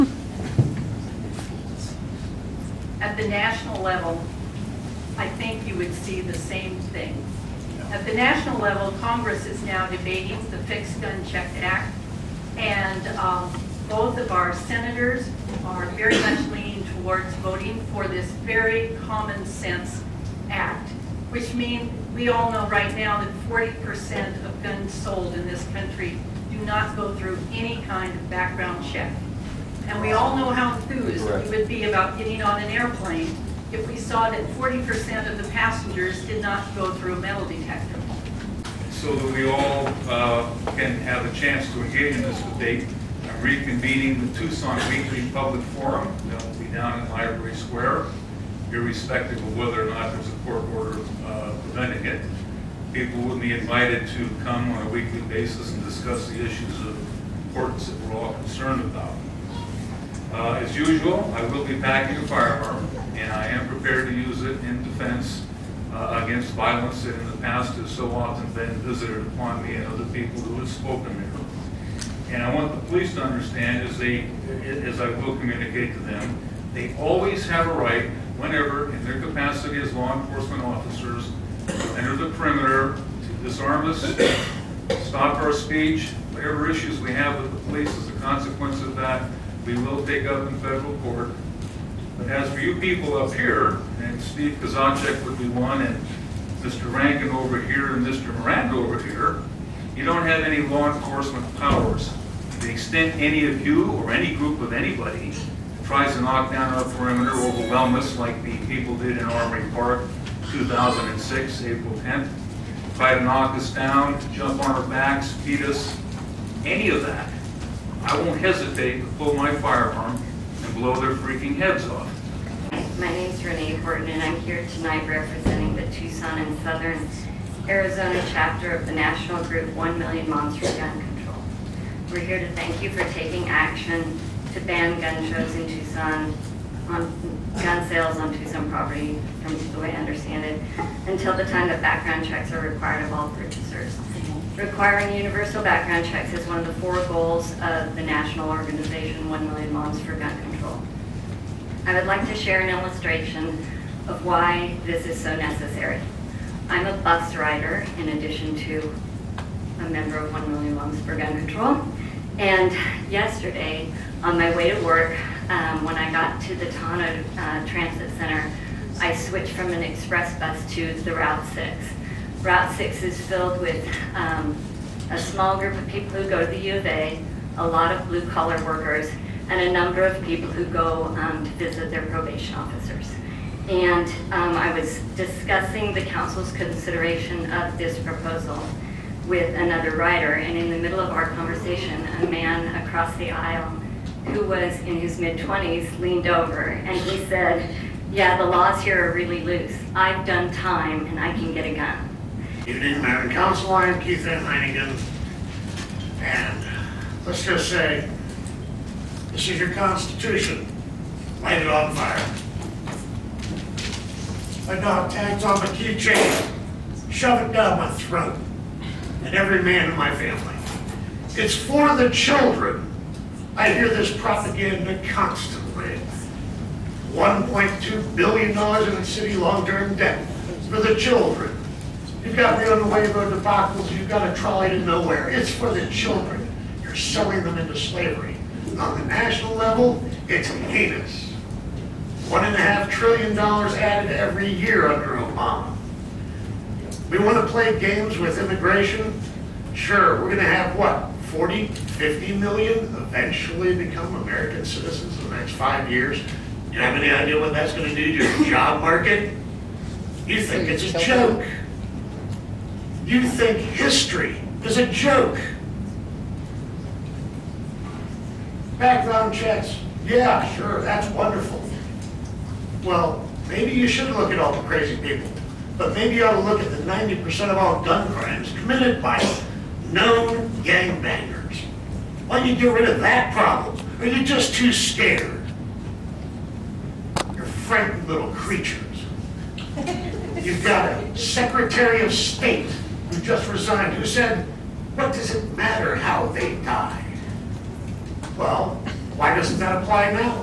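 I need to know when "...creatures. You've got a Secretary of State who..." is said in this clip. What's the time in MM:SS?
04:48.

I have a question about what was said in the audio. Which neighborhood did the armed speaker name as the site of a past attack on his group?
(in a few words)
Armory Park.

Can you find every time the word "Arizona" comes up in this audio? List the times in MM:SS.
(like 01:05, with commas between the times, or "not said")
02:07.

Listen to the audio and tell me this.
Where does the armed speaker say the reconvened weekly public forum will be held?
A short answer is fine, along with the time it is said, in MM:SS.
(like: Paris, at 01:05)
Library Square, at 00:47.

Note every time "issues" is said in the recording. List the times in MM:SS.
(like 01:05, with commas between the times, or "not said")
00:56, 01:26.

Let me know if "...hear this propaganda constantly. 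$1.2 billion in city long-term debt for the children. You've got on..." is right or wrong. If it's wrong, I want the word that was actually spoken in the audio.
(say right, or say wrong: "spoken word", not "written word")
right.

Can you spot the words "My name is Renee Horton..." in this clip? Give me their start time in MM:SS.
02:03.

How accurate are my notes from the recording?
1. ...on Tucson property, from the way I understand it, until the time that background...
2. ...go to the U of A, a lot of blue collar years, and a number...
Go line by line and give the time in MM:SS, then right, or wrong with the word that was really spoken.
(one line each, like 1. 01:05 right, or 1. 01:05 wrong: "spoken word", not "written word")
1. 02:18 right
2. 02:56 wrong: "workers", not "years".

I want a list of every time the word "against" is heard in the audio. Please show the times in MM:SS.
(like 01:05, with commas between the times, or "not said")
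01:06.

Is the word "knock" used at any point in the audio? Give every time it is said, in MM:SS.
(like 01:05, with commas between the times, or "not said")
01:46, 01:53.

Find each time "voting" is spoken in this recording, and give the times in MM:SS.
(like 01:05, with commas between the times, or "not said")
00:17.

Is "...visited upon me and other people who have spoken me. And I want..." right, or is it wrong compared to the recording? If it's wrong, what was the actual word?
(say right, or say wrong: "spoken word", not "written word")
right.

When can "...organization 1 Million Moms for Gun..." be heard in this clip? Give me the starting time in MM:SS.
02:28.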